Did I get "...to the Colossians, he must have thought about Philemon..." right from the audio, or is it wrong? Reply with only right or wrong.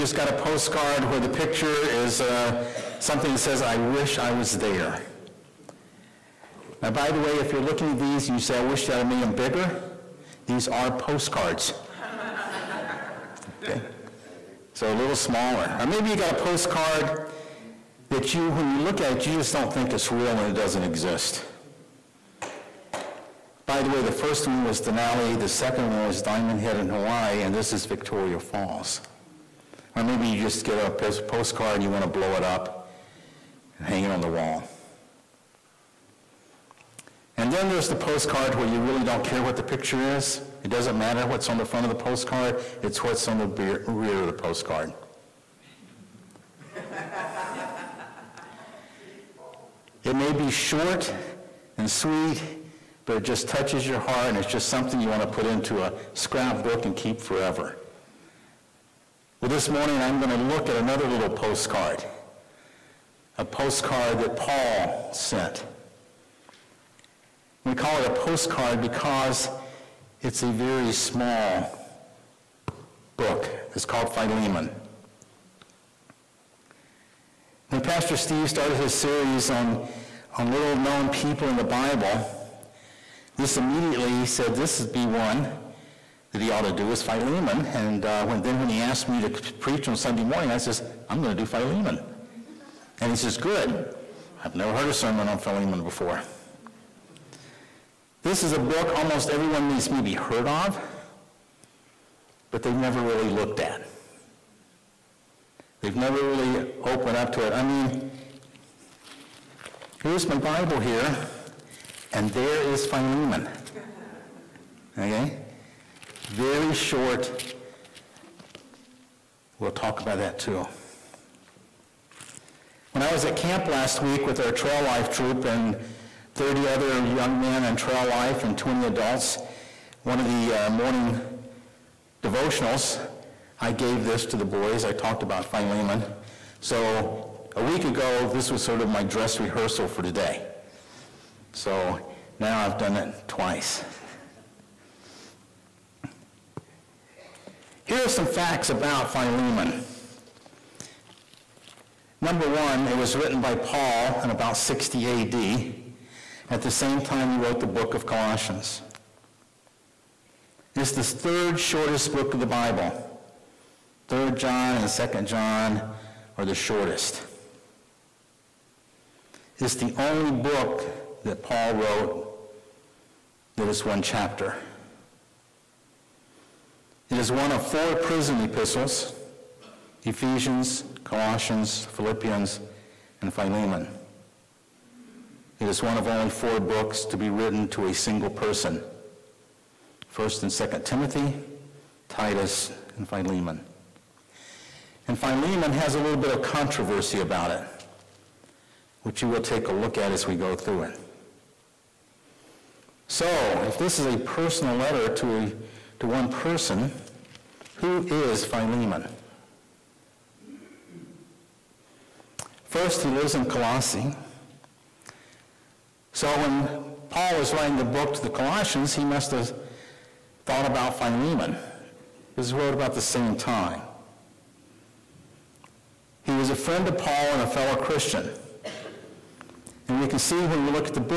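right.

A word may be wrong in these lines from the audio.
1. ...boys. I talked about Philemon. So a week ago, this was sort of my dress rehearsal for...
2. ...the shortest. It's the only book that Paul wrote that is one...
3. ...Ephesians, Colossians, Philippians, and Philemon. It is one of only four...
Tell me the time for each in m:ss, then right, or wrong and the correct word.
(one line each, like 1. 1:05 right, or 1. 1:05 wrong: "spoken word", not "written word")
1. 2:14 right
2. 2:46 right
3. 3:00 right.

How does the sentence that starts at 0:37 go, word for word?
And then there's the postcard where you really don't care what the picture is.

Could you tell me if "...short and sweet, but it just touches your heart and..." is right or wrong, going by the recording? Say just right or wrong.
right.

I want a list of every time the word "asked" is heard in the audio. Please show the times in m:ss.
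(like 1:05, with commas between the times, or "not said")
1:28.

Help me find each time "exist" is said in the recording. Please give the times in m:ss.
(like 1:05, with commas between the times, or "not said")
0:20.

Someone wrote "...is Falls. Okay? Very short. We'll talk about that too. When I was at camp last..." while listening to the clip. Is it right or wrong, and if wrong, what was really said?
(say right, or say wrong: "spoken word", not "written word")
wrong: "Philemon", not "Falls".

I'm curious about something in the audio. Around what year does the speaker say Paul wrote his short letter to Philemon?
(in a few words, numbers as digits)
60 AD.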